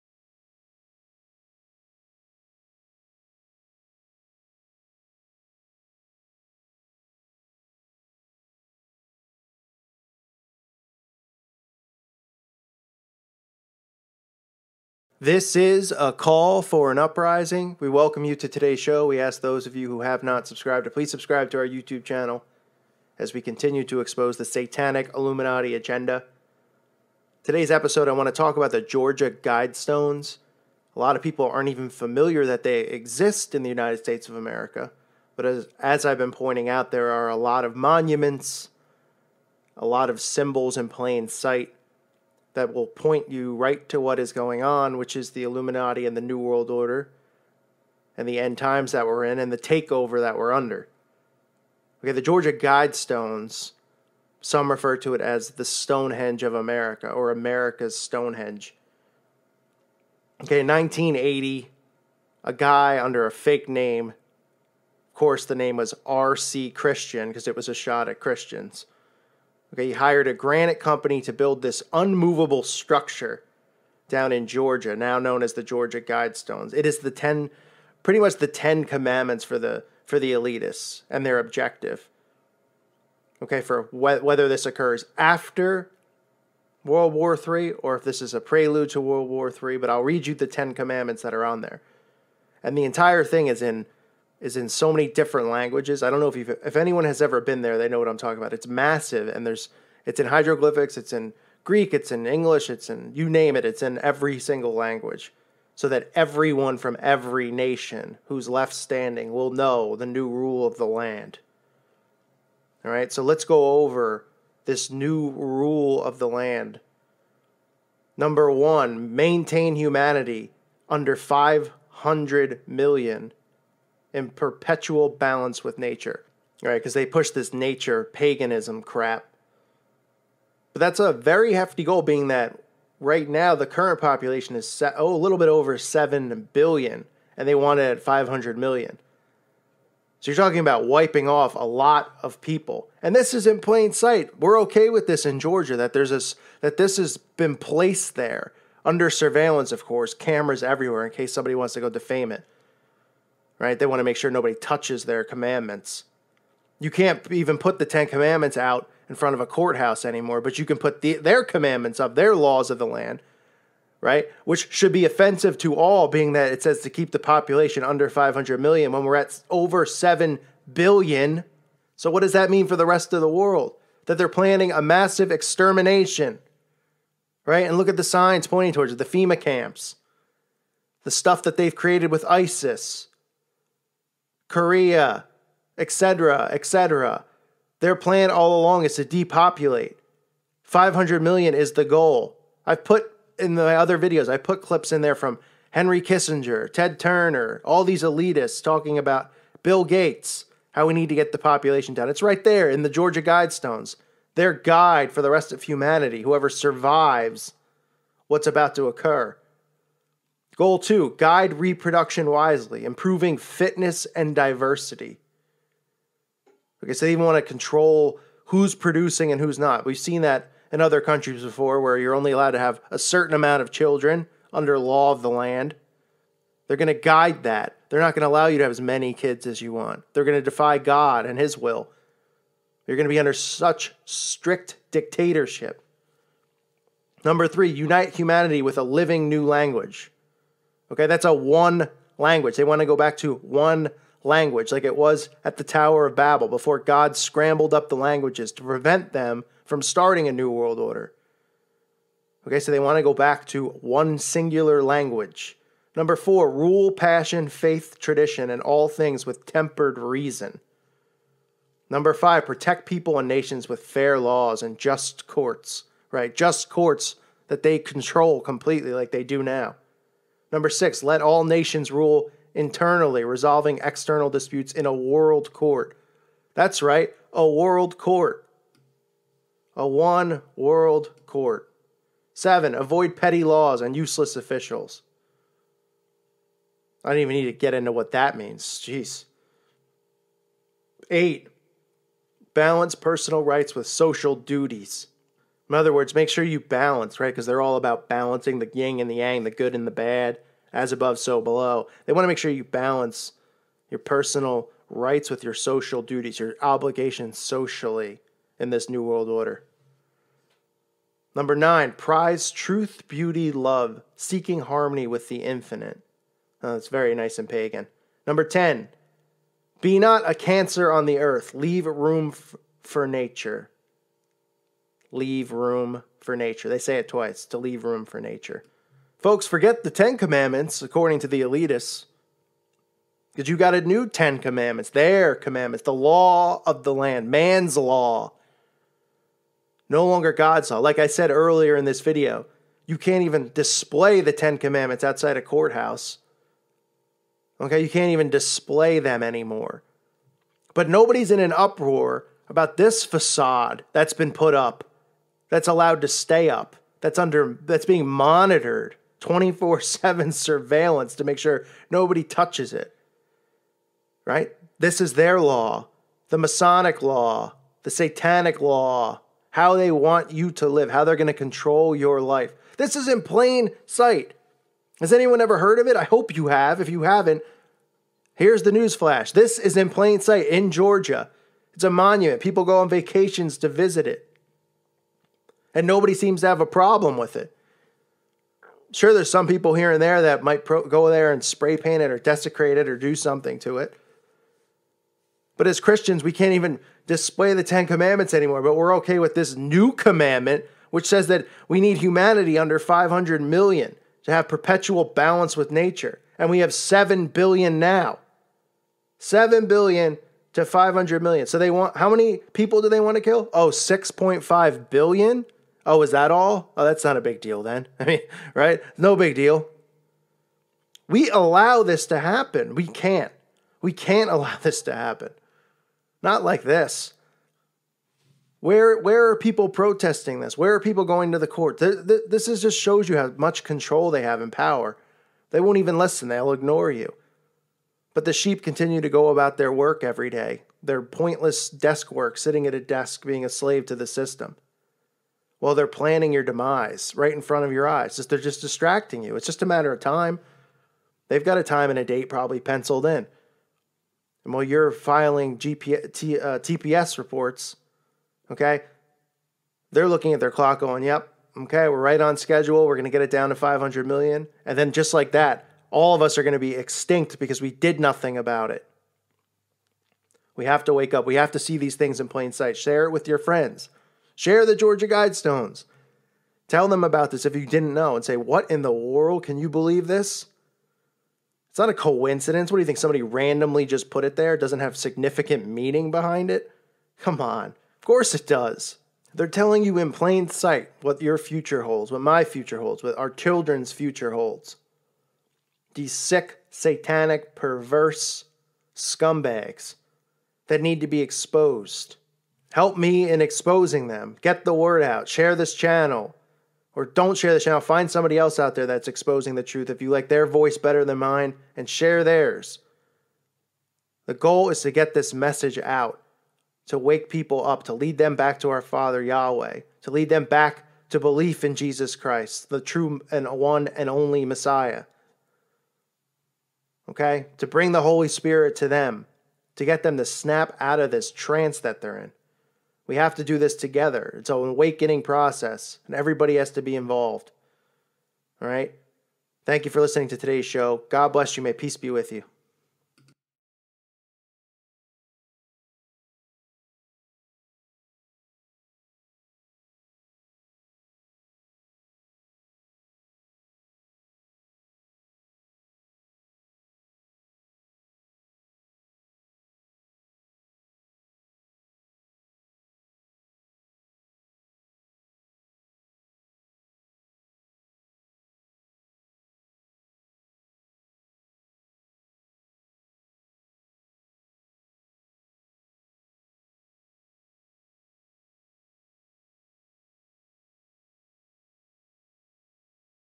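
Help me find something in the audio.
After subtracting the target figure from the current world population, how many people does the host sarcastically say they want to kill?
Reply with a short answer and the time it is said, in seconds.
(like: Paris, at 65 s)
6.5 billion, at 413 s.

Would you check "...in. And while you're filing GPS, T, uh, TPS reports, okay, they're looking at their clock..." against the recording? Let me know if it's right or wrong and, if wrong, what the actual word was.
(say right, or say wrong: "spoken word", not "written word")
right.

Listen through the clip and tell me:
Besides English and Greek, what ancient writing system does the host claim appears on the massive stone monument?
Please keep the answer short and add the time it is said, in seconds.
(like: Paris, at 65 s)
hieroglyphics, at 100 s.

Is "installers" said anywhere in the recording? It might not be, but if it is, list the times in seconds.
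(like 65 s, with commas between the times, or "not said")
not said.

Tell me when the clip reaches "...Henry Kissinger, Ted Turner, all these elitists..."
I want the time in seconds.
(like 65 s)
195 s.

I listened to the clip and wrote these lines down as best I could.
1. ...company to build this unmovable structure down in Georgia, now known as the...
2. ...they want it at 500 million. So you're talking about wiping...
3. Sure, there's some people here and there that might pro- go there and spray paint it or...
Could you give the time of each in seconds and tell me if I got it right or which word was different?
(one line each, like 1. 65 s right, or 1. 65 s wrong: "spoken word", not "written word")
1. 70 s right
2. 137 s right
3. 388 s right.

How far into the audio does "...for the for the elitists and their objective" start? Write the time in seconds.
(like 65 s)
79 s.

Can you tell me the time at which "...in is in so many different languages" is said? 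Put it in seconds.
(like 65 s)
93 s.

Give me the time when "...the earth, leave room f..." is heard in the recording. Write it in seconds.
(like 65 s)
321 s.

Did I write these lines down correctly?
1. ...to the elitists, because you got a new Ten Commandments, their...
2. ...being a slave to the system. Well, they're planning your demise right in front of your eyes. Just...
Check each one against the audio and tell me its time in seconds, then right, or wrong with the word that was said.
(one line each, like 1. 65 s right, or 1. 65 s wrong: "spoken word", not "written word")
1. 331 s right
2. 443 s right.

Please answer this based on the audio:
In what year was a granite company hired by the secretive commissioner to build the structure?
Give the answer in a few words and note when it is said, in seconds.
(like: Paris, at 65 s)
1980, at 60 s.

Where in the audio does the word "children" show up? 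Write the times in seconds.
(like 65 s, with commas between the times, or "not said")
223 s, 493 s.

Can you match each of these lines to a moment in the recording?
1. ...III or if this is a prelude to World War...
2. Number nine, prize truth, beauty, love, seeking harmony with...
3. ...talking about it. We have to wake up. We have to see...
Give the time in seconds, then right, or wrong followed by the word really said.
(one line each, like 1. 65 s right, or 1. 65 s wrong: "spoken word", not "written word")
1. 87 s right
2. 311 s right
3. 467 s wrong: "nothing", not "talking".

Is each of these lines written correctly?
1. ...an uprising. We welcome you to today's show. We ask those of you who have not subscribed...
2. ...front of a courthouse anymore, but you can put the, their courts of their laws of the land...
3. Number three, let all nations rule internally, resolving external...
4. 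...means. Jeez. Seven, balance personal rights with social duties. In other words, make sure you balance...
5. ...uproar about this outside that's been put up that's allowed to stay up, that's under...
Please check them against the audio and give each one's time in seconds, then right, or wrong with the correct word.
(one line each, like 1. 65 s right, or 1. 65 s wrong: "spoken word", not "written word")
1. 16 s right
2. 159 s wrong: "commandments", not "courts"
3. 270 s wrong: "six", not "three"
4. 288 s wrong: "Eight", not "Seven"
5. 351 s wrong: "facade", not "outside".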